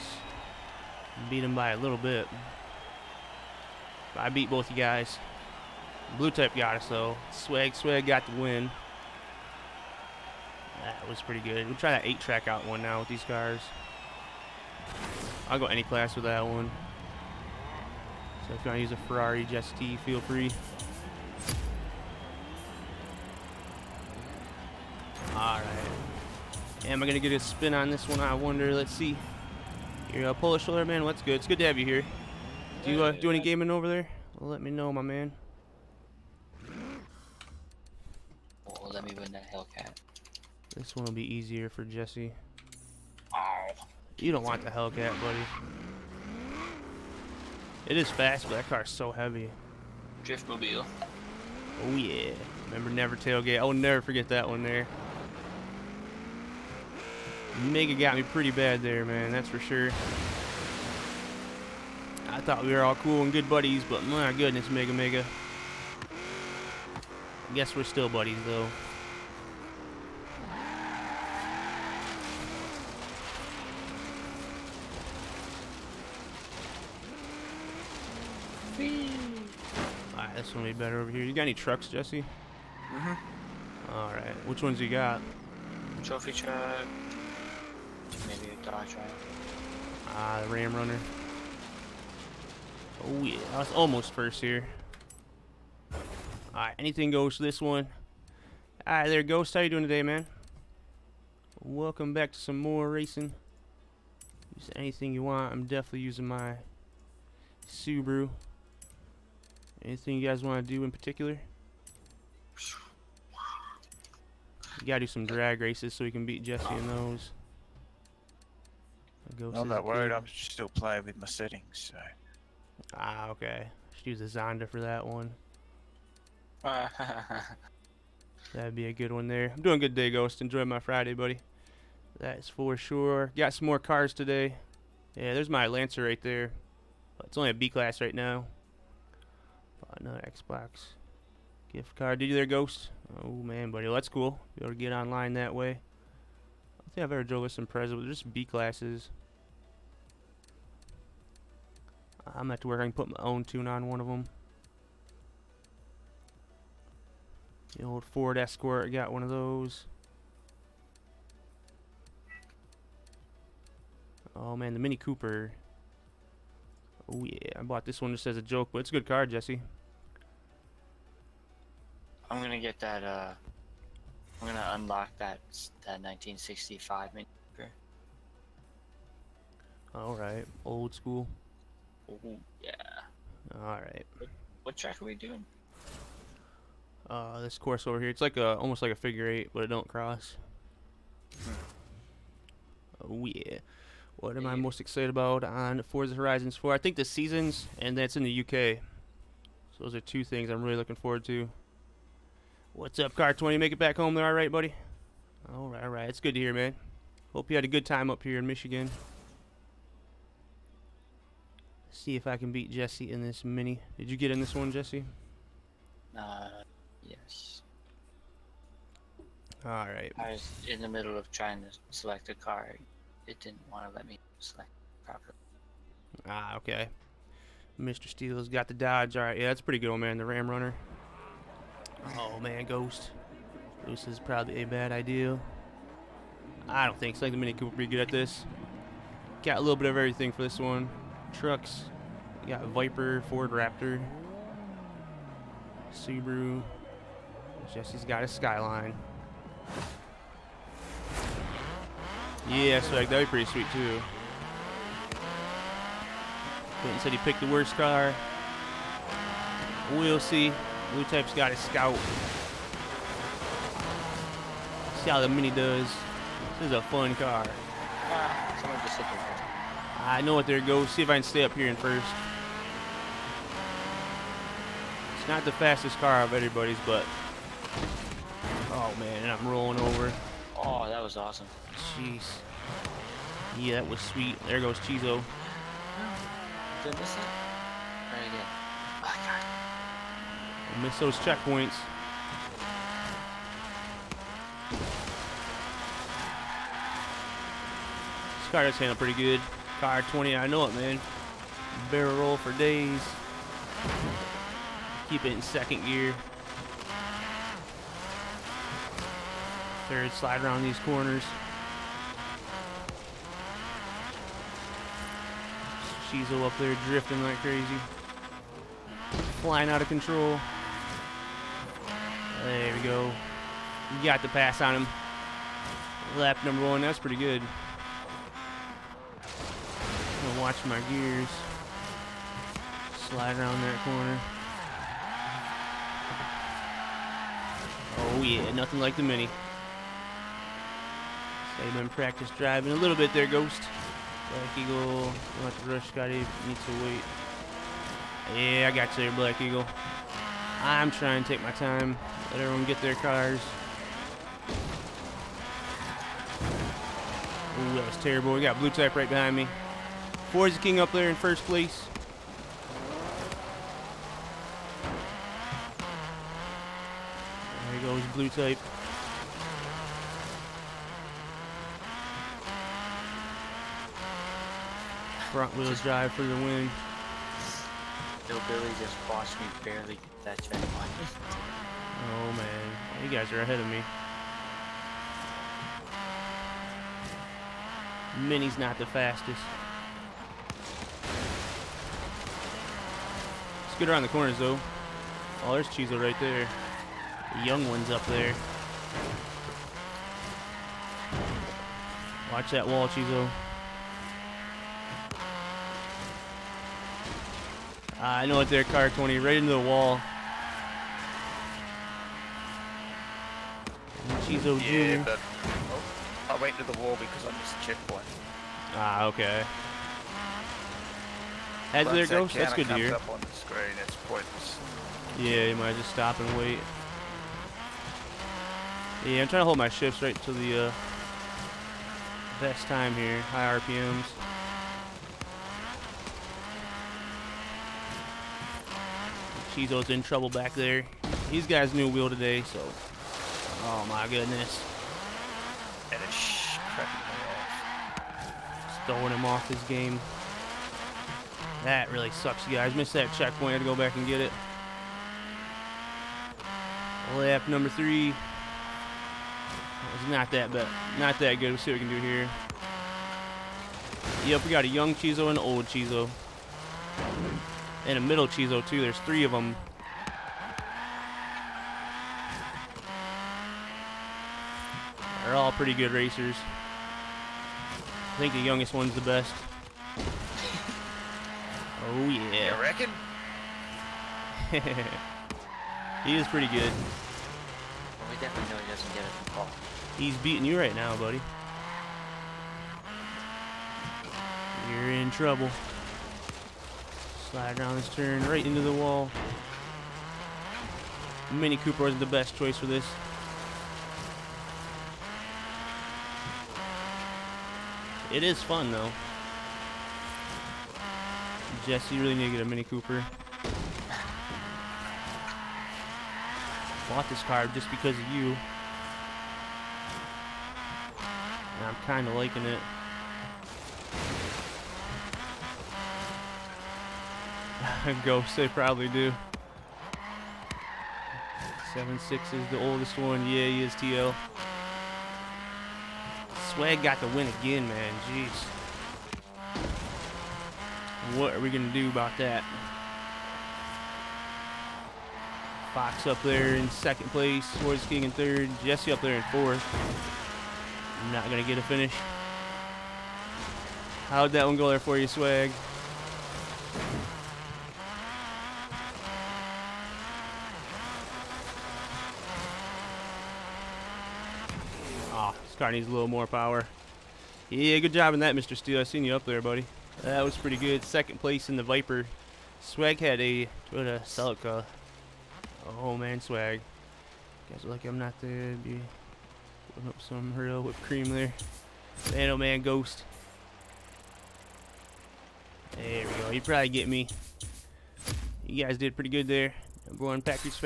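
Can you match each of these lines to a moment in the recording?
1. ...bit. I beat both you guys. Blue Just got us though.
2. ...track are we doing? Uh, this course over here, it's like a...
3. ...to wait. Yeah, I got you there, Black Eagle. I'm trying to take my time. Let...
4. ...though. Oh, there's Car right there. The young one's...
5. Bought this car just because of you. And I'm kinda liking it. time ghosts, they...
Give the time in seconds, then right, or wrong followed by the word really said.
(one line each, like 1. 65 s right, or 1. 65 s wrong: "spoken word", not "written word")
1. 1 s wrong: "Type", not "Just"
2. 184 s right
3. 346 s right
4. 394 s wrong: "Chizo", not "Car"
5. 516 s right.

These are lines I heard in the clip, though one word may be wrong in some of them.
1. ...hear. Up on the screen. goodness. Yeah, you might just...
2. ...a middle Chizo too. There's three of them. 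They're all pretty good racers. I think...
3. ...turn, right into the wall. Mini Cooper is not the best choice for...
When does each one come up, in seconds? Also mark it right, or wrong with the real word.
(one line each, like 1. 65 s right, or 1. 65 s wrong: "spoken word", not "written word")
1. 422 s wrong: "pointless", not "goodness"
2. 467 s right
3. 497 s right.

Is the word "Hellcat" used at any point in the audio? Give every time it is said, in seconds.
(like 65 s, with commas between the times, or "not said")
39 s, 44 s.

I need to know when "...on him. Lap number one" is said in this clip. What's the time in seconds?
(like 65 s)
324 s.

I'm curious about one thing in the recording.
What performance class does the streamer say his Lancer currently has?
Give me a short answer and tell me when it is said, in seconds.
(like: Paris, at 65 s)
B class, at 137 s.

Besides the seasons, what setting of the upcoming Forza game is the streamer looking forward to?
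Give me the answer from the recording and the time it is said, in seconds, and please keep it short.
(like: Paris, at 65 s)
the UK, at 198 s.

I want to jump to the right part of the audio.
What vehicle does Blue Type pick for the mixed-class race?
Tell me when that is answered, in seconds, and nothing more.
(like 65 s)
261 s.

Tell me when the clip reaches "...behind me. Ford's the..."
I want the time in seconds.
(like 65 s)
359 s.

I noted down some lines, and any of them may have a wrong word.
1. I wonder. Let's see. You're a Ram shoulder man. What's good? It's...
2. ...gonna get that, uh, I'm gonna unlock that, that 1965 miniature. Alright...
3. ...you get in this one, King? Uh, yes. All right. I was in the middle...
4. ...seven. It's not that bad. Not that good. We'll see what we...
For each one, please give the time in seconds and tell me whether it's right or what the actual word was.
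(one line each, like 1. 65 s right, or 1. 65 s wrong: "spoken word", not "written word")
1. 28 s wrong: "Polish", not "Ram"
2. 172 s right
3. 214 s wrong: "Jesse", not "King"
4. 457 s wrong: "three", not "seven".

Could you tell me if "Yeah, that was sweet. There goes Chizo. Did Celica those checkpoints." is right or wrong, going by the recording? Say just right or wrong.
wrong.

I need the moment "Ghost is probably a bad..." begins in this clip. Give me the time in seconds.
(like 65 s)
233 s.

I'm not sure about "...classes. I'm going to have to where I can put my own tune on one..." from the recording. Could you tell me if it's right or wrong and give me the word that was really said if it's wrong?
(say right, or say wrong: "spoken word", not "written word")
right.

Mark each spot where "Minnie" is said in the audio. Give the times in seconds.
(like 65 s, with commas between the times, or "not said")
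388 s.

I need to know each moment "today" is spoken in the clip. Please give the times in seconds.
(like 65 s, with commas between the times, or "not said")
99 s, 134 s, 442 s.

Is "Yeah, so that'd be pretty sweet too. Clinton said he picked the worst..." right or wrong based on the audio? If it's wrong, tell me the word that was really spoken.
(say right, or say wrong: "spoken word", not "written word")
right.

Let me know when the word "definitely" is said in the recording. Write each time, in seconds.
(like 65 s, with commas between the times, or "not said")
105 s, 488 s.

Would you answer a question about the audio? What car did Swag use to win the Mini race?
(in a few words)
Toyota Celica.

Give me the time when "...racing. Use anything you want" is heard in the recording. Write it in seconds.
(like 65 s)
102 s.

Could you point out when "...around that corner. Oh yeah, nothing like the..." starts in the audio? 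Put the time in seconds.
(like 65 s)
333 s.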